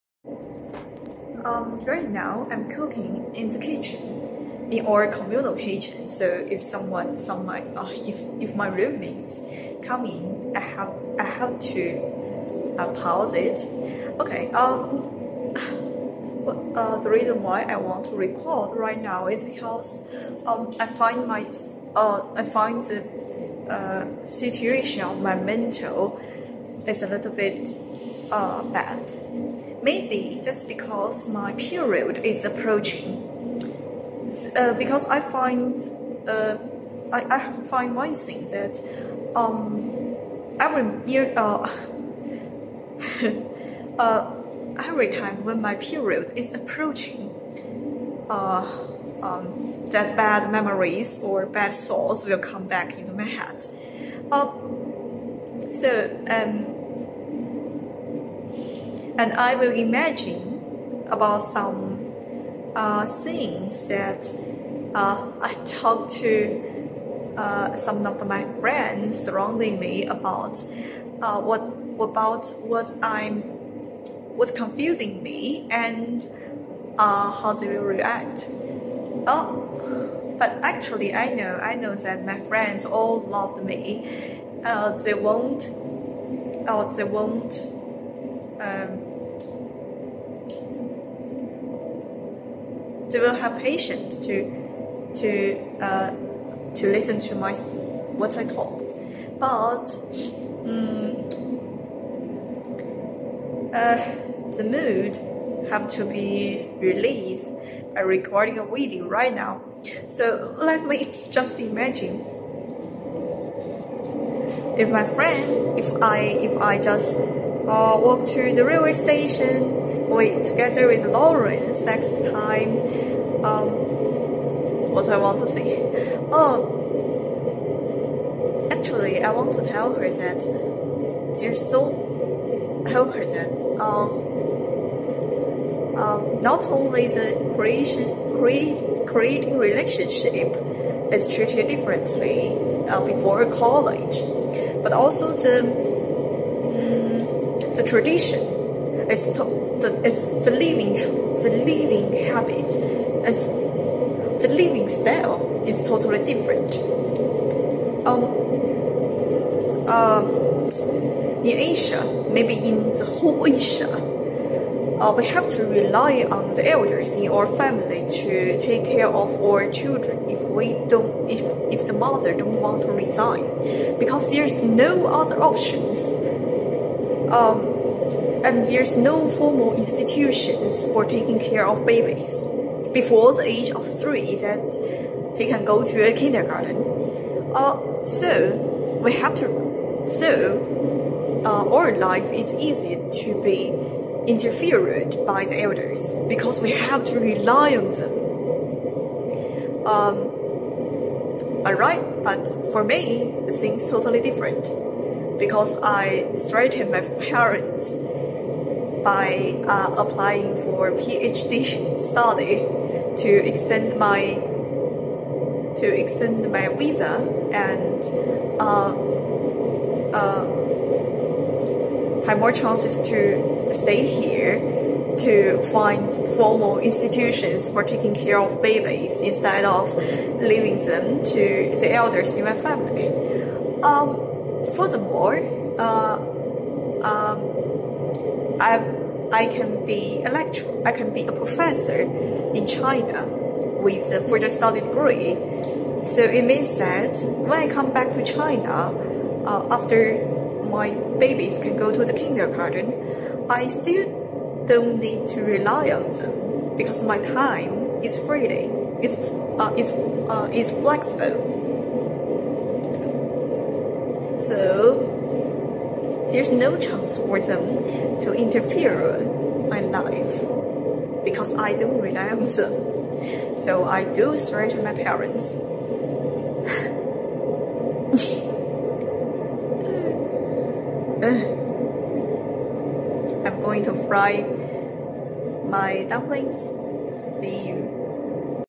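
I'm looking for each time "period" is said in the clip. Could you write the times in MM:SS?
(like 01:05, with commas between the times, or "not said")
00:31, 00:45.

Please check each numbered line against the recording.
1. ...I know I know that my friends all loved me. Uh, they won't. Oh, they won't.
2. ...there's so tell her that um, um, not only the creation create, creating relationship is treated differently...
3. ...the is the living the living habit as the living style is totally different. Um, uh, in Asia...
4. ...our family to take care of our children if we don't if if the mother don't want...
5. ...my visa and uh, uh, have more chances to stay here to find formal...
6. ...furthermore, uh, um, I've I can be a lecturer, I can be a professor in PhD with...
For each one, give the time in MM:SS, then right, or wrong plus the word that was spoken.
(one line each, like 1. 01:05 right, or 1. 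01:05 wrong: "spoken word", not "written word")
1. 01:21 right
2. 02:11 right
3. 02:29 right
4. 02:47 right
5. 03:36 right
6. 03:54 wrong: "China", not "PhD".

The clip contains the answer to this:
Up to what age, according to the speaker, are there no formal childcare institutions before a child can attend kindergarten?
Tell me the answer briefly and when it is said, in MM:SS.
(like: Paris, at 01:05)
3, at 03:03.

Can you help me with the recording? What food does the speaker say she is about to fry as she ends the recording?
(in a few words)
Dumplings.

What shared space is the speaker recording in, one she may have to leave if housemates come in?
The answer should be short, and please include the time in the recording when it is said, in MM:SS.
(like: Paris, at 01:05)
Communal kitchen, at 00:05.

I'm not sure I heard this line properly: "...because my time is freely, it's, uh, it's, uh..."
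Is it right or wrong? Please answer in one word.
right.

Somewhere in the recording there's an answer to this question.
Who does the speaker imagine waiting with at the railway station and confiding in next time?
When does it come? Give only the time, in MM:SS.
02:01.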